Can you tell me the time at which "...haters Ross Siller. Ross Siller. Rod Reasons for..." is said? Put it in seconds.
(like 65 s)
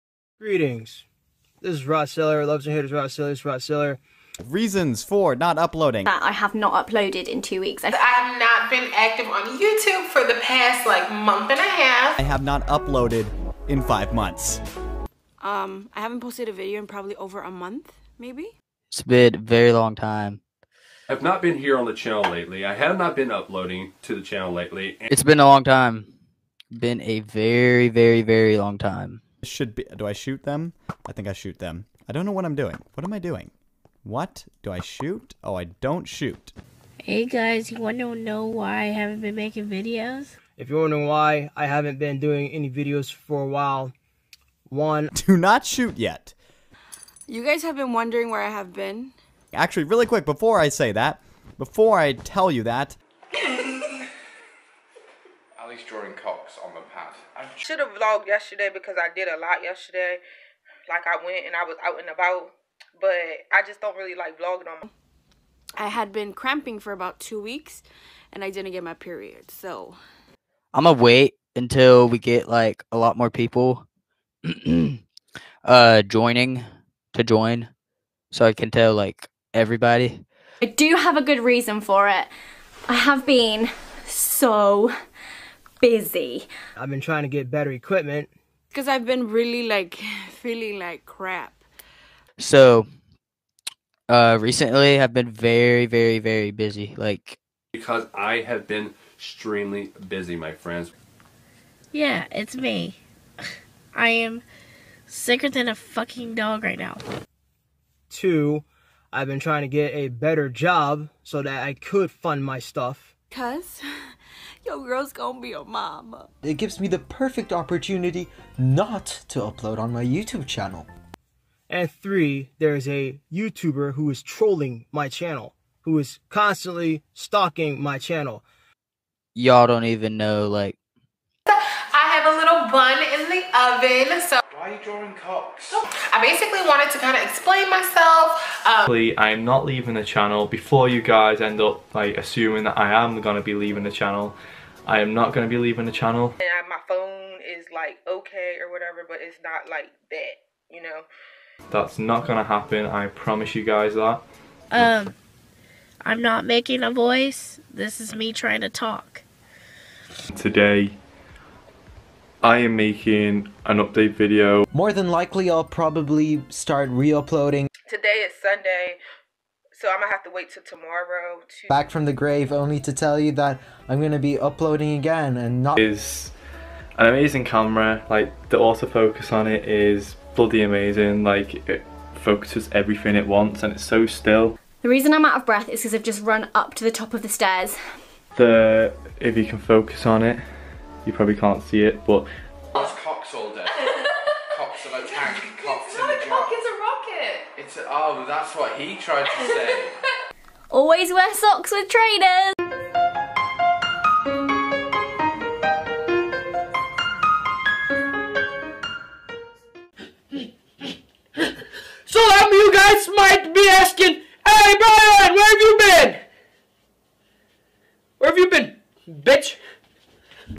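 2 s.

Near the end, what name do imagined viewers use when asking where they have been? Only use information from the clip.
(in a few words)
Brian.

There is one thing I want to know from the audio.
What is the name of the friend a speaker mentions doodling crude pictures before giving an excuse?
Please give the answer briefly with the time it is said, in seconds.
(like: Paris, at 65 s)
Ali, at 55 s.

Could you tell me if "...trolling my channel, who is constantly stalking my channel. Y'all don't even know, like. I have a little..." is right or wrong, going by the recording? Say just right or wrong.
right.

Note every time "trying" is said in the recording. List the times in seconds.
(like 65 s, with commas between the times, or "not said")
87 s, 109 s, 158 s.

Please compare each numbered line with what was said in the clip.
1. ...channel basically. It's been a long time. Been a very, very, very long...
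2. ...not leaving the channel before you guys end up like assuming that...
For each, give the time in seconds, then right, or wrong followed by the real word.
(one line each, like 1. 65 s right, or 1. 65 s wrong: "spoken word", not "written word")
1. 24 s wrong: "lately", not "basically"
2. 139 s right.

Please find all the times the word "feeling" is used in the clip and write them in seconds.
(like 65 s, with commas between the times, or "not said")
90 s.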